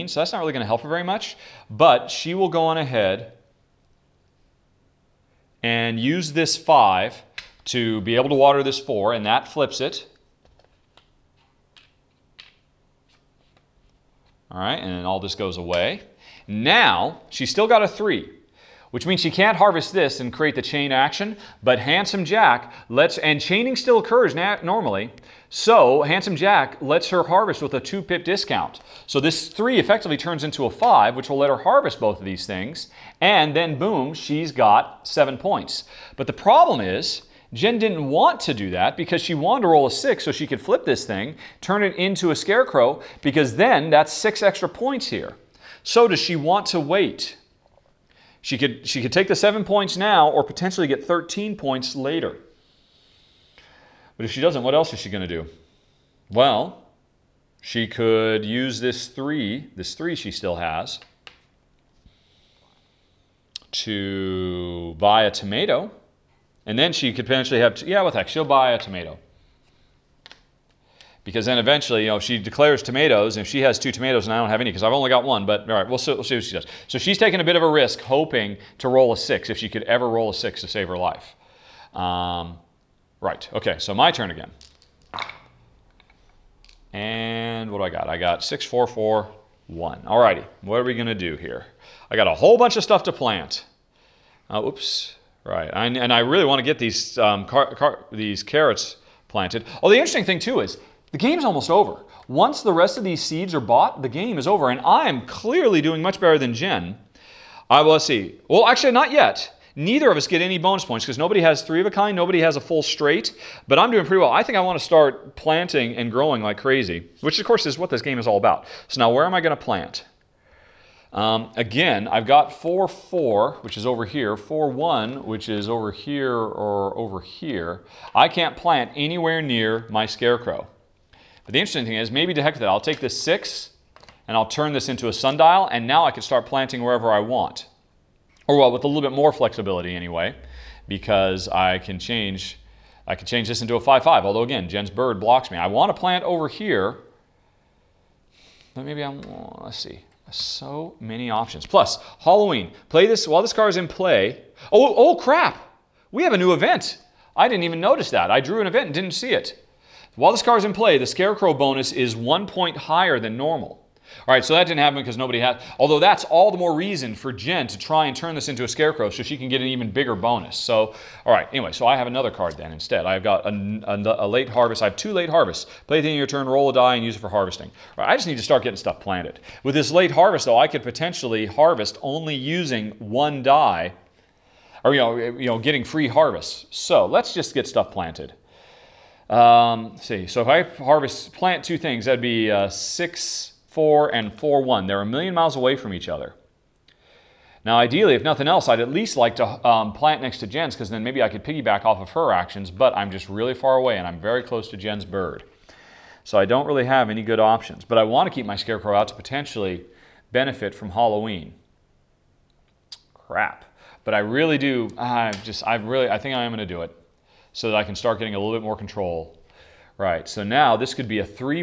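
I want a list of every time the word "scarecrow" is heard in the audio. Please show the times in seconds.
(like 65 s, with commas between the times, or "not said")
42 s, 130 s, 161 s, 168 s, 208 s.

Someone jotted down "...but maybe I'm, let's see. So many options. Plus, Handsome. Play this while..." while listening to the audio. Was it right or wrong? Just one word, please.
wrong.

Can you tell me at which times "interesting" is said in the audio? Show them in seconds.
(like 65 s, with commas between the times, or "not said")
99 s, 131 s.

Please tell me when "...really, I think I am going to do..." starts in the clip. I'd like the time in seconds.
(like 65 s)
215 s.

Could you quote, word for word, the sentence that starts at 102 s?
Once the rest of these seeds are bought, the game is over, and I am clearly doing much better than Jen.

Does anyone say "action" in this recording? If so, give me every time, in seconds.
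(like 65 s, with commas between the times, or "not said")
20 s, 202 s.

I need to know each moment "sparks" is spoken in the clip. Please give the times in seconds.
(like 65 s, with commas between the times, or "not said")
not said.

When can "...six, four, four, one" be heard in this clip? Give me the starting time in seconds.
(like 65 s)
88 s.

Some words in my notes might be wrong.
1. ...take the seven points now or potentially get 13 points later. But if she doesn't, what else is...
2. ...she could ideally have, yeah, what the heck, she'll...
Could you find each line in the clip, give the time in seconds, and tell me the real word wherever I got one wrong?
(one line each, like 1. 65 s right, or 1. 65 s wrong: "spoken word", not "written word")
1. 49 s right
2. 66 s wrong: "potentially", not "ideally".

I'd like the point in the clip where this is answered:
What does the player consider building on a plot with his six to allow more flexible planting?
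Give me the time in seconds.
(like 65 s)
135 s.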